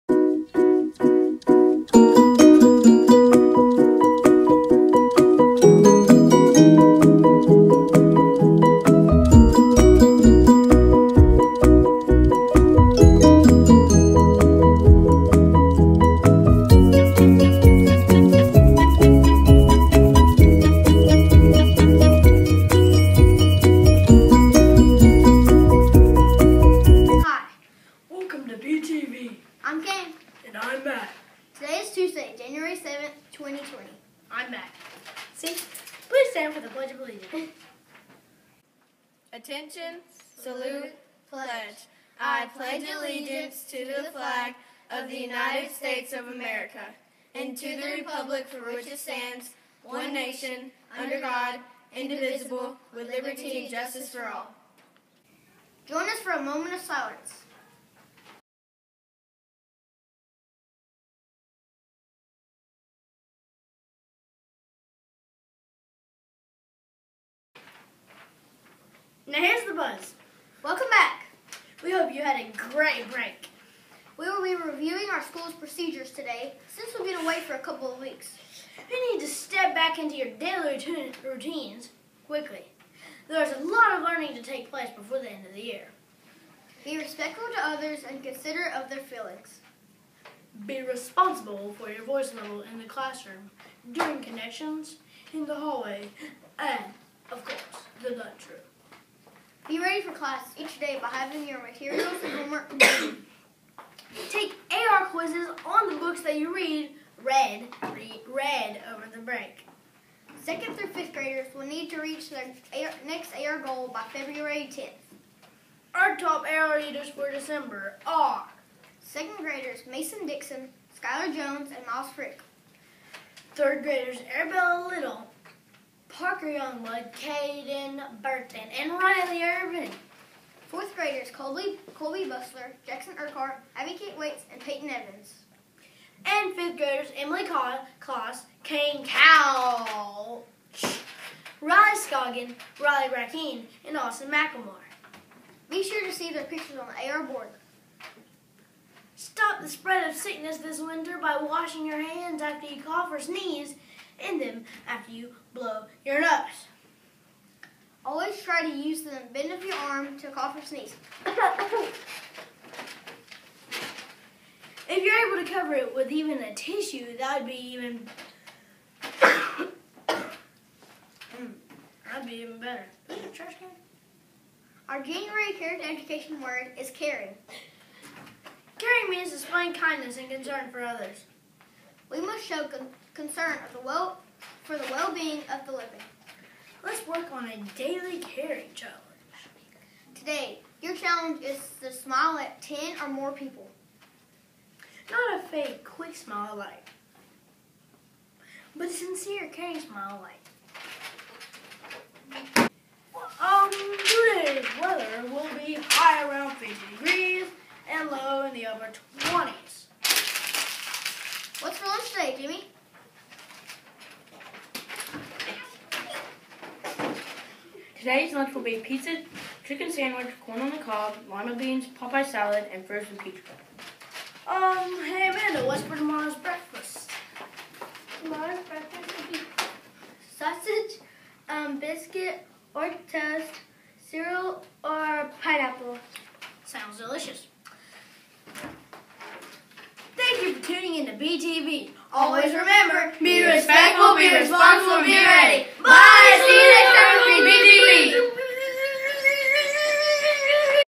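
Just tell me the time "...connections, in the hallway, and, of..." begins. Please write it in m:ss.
1:34.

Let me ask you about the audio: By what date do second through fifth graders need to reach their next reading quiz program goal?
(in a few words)
February 10th.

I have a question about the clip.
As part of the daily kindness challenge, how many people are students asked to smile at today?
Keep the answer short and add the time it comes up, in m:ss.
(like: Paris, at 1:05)
10, at 3:12.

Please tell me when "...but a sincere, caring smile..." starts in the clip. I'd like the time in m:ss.
3:18.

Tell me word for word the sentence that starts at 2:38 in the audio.
Always try to use the bend of your arm to cough or sneeze.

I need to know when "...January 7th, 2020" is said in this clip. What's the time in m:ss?
0:32.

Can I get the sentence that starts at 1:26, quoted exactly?
Be respectful to others and considerate of their feelings.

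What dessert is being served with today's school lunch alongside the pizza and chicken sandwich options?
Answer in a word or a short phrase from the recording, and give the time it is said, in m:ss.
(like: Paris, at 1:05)
frozen peach pie, at 3:42.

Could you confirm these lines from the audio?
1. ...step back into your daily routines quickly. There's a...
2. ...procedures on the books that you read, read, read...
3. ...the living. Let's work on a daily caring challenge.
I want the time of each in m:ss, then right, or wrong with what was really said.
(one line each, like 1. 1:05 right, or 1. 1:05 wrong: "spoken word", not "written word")
1. 1:19 right
2. 1:45 wrong: "quizzes", not "procedures"
3. 3:05 right.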